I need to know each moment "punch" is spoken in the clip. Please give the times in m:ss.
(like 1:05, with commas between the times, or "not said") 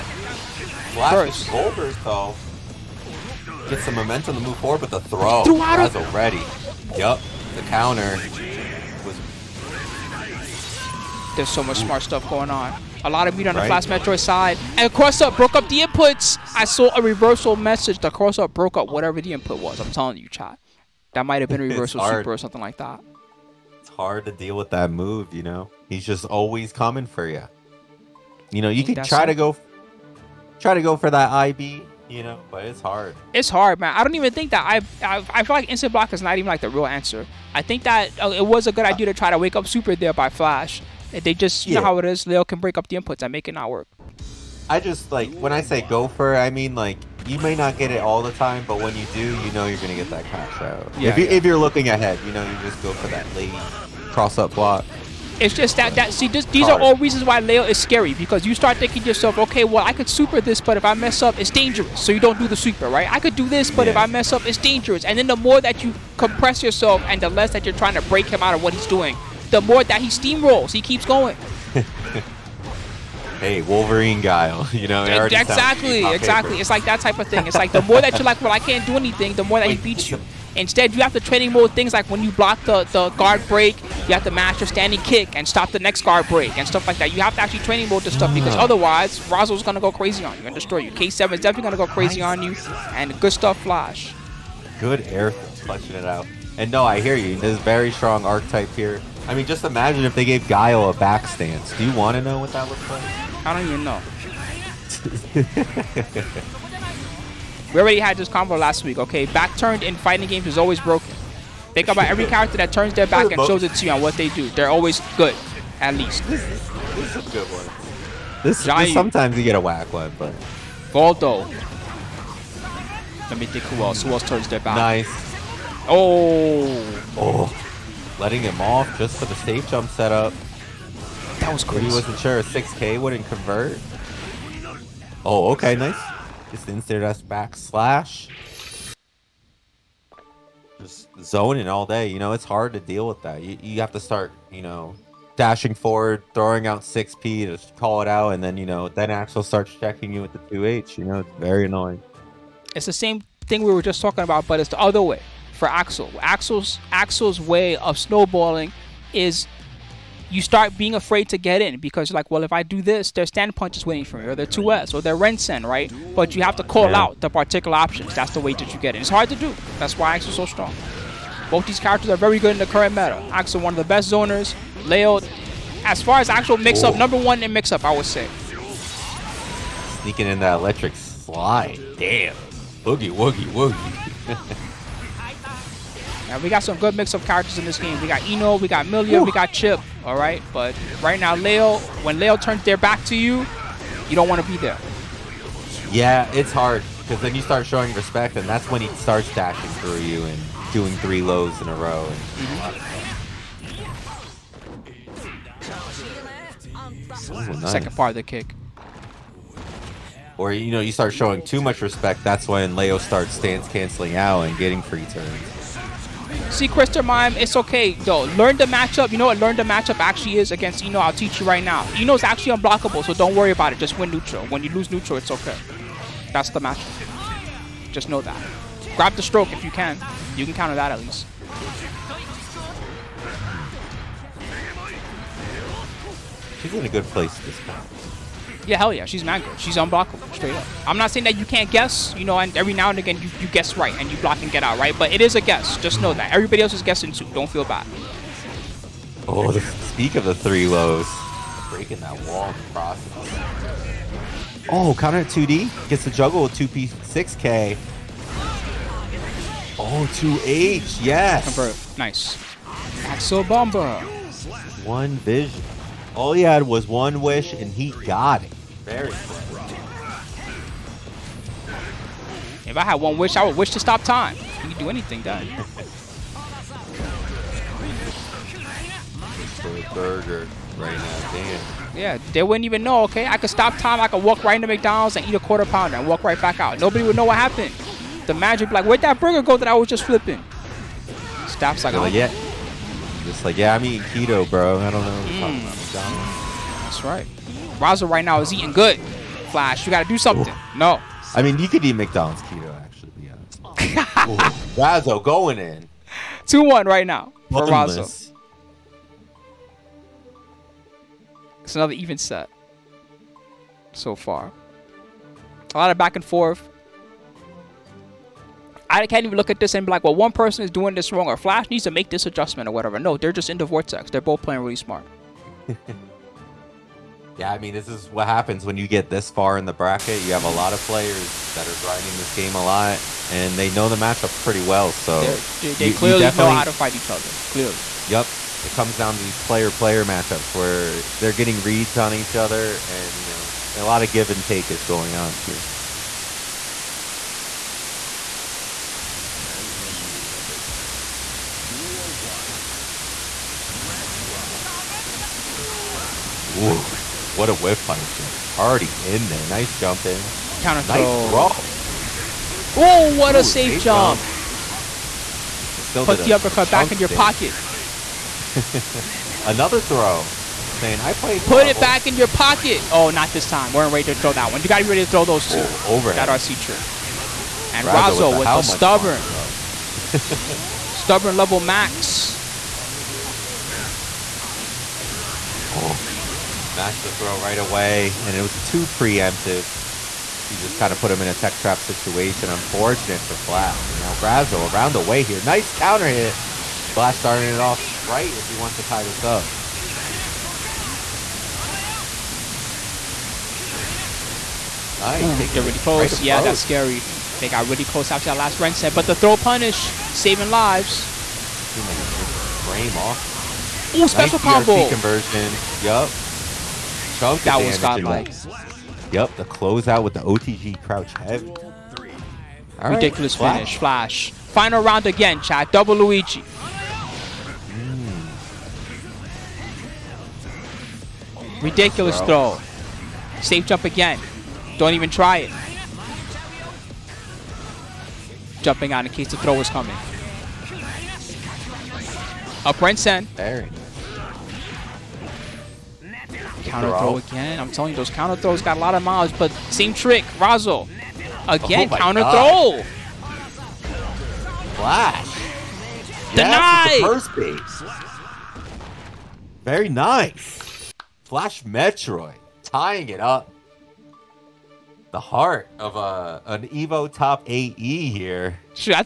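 2:43.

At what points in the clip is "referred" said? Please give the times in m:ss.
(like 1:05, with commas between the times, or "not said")
not said.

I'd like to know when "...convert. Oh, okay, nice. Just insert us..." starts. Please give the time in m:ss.
2:13.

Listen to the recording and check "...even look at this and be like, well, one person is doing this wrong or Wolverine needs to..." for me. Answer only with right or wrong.
wrong.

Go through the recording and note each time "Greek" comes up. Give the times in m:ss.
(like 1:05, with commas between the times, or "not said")
not said.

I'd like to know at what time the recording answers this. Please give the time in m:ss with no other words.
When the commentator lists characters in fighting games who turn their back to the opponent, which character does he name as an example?
2:00.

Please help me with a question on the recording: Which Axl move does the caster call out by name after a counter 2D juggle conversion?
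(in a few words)
Axl Bomber.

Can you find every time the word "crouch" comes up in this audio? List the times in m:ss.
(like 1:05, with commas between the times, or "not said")
7:00.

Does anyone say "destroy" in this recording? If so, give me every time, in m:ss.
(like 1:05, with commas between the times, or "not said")
1:30.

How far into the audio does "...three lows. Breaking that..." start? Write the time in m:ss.
4:10.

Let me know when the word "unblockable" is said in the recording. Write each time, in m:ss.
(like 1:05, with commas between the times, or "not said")
3:42, 3:59.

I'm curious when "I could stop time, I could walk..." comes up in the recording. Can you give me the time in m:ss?
4:43.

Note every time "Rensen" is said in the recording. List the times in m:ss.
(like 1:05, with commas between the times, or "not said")
2:45, 7:22.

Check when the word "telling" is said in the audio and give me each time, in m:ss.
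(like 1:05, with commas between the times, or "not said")
0:19, 7:27.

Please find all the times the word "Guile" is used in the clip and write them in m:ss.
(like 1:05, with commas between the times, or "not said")
1:14, 1:40.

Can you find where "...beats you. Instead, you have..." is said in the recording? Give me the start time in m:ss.
1:19.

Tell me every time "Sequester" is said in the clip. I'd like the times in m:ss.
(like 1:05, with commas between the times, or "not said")
3:36.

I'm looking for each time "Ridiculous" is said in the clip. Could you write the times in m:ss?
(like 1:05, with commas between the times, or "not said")
7:02, 7:11.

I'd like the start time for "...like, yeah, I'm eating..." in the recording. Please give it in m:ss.
4:53.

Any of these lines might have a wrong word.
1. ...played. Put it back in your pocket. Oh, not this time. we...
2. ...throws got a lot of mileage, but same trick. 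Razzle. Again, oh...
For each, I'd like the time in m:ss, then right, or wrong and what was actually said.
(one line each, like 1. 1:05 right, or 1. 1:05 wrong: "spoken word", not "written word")
1. 6:11 right
2. 7:28 right.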